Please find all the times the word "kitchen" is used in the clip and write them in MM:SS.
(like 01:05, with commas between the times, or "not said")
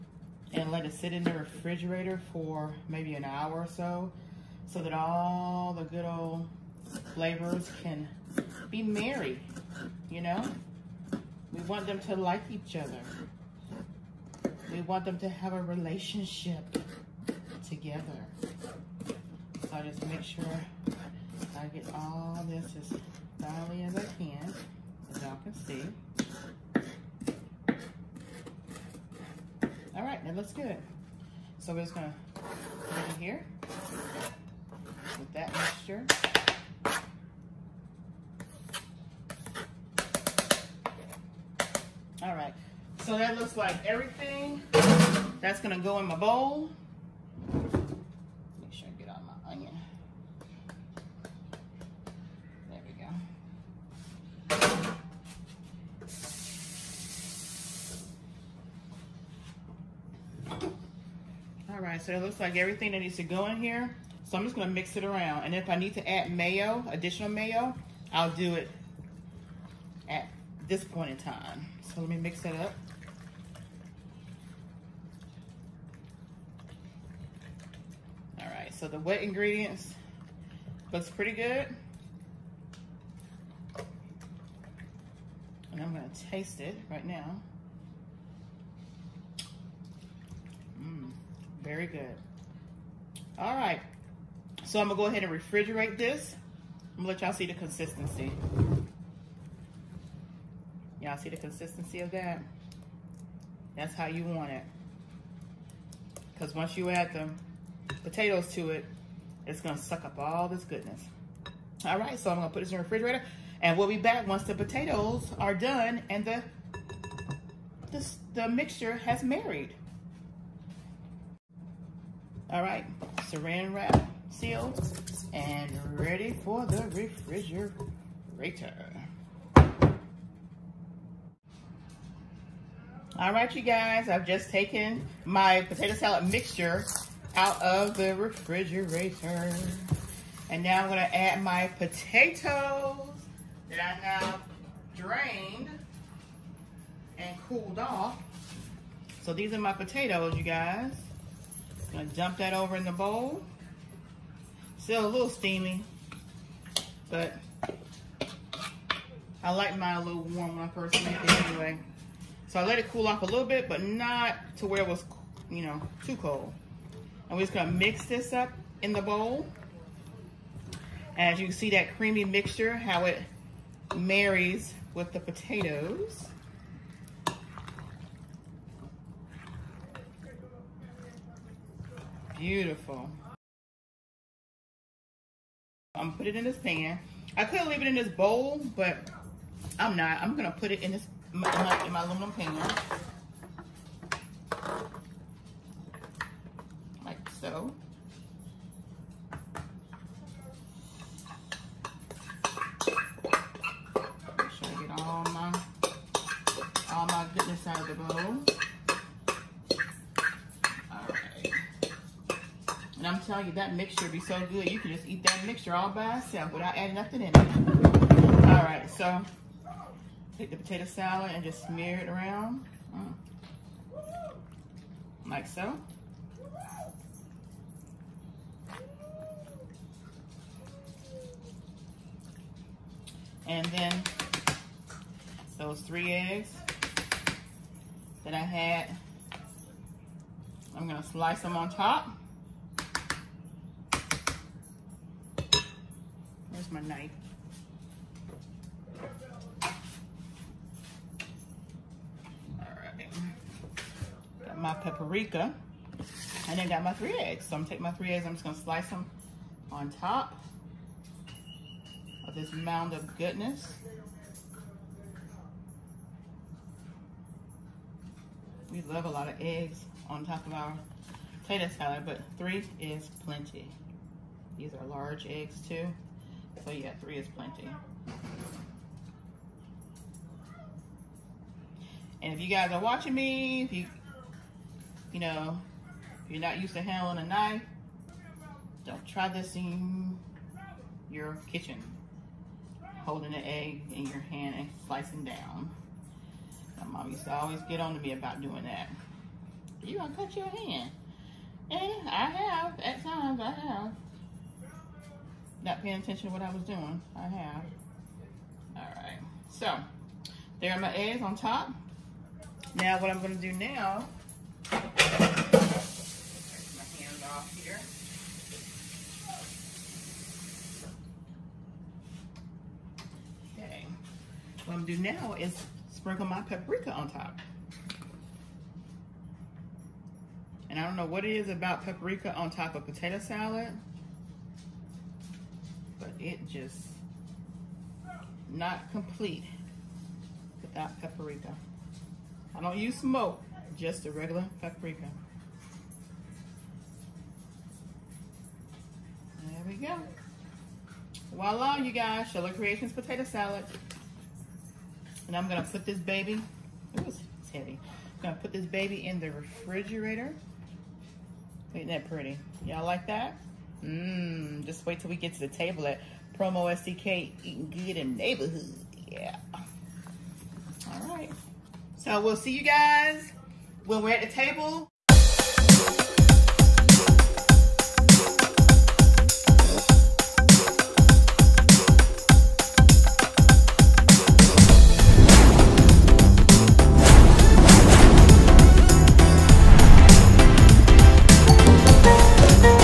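04:51.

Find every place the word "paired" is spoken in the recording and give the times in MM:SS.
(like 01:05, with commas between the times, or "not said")
not said.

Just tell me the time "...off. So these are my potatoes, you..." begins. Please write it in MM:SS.
02:27.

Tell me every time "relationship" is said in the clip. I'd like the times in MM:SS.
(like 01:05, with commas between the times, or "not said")
00:15.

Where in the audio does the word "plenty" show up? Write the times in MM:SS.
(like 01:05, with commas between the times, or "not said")
04:33, 04:37.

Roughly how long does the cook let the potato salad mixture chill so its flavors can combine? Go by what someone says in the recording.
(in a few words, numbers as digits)
an hour.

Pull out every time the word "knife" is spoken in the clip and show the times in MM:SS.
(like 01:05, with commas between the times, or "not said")
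04:06, 04:47.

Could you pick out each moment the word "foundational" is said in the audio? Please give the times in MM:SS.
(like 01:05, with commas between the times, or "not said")
not said.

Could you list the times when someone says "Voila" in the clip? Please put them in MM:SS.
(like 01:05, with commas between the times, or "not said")
05:51.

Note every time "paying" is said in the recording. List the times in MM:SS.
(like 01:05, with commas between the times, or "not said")
05:05.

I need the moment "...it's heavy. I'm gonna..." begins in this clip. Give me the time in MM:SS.
05:57.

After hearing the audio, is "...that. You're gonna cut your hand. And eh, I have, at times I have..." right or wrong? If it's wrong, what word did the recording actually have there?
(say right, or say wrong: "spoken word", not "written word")
right.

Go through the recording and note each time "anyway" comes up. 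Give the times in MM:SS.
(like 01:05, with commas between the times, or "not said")
02:41.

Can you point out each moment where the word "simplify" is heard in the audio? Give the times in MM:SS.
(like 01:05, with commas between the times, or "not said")
not said.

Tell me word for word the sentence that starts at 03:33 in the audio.
I'm telling you, that mixture be so good.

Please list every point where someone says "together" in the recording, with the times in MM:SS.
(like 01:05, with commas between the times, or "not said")
00:17.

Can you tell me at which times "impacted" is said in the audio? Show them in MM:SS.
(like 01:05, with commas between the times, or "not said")
not said.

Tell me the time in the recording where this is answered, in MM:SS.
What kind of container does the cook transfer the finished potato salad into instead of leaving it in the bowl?
03:12.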